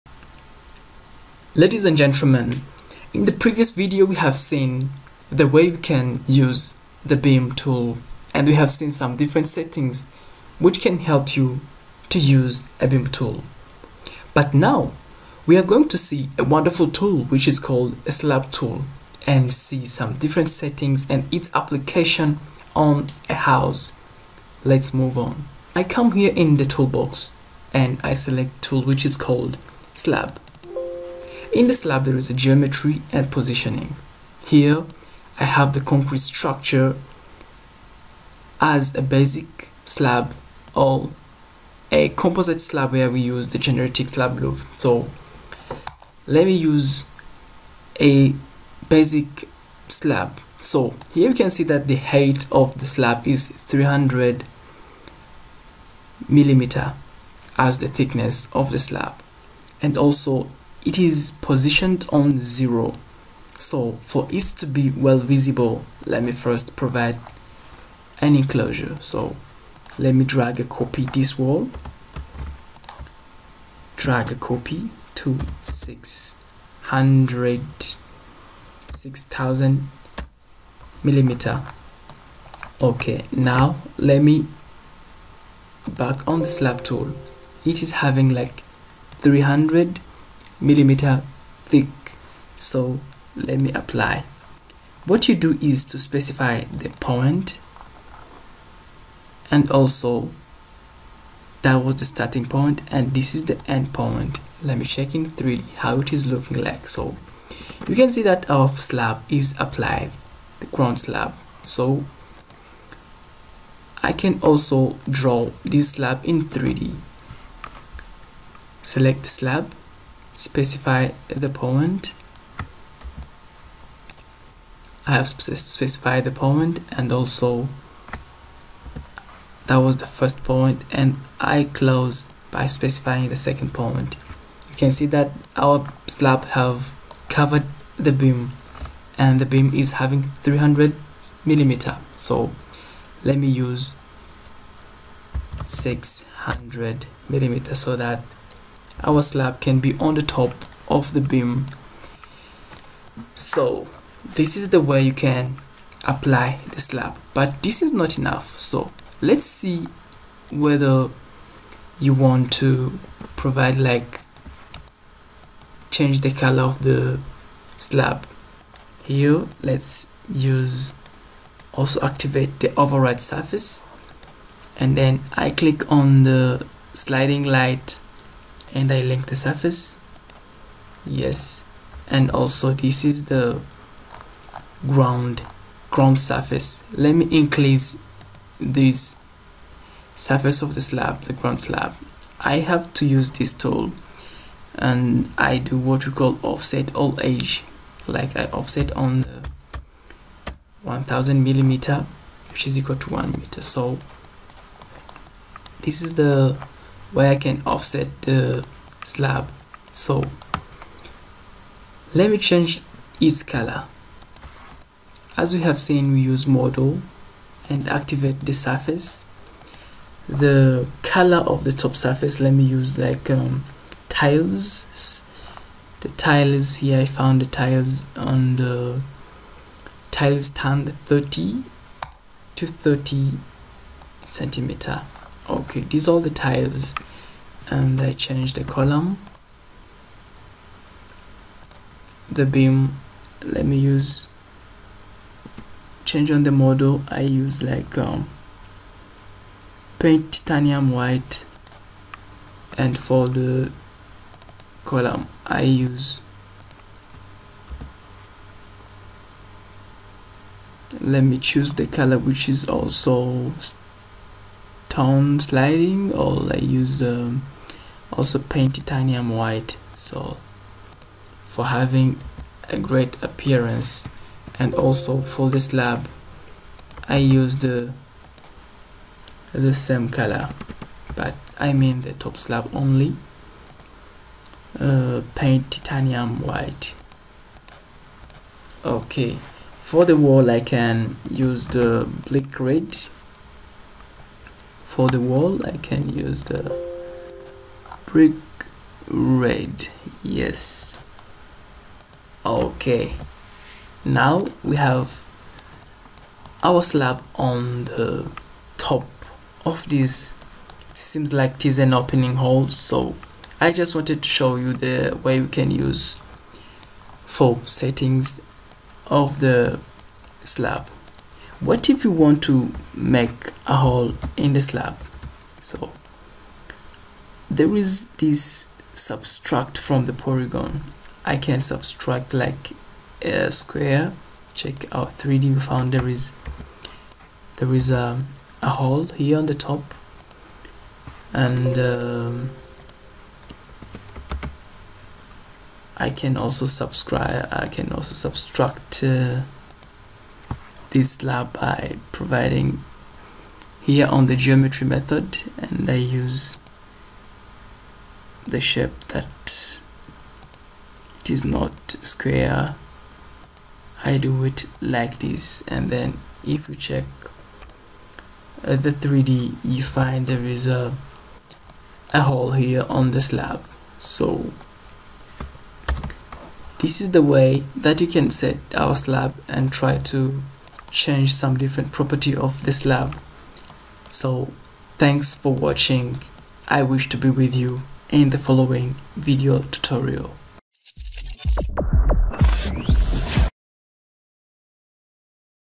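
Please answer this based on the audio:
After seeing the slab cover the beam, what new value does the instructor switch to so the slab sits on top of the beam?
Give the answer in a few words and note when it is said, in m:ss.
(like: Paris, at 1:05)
600 millimeter, at 2:25.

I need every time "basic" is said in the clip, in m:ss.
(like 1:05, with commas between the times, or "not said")
0:39, 0:48.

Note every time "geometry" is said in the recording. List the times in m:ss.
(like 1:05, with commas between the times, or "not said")
0:32, 5:54.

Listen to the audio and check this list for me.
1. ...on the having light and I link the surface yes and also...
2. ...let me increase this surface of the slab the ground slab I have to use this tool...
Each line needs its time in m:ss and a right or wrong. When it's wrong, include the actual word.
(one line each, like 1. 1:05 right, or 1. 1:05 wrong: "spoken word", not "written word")
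1. 2:55 wrong: "sliding", not "having"
2. 3:06 right.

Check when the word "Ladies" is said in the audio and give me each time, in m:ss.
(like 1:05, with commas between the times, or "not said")
0:01.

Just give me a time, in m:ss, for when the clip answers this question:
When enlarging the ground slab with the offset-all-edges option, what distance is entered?
3:20.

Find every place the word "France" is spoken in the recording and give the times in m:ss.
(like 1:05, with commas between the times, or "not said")
not said.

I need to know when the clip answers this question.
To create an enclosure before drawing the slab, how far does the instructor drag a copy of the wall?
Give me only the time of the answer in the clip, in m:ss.
1:18.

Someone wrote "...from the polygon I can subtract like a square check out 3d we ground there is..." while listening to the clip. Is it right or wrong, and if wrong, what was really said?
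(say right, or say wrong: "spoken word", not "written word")
wrong: "found", not "ground".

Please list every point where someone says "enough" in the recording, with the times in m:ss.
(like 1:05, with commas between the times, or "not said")
2:38.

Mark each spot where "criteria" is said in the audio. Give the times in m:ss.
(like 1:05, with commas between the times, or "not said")
not said.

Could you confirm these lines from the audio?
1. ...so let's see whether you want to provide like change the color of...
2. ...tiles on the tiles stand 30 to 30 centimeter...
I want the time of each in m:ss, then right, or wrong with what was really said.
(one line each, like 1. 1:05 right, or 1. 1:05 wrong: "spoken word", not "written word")
1. 2:38 right
2. 3:47 right.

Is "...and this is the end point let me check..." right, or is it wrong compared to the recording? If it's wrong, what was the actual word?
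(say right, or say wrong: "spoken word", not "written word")
right.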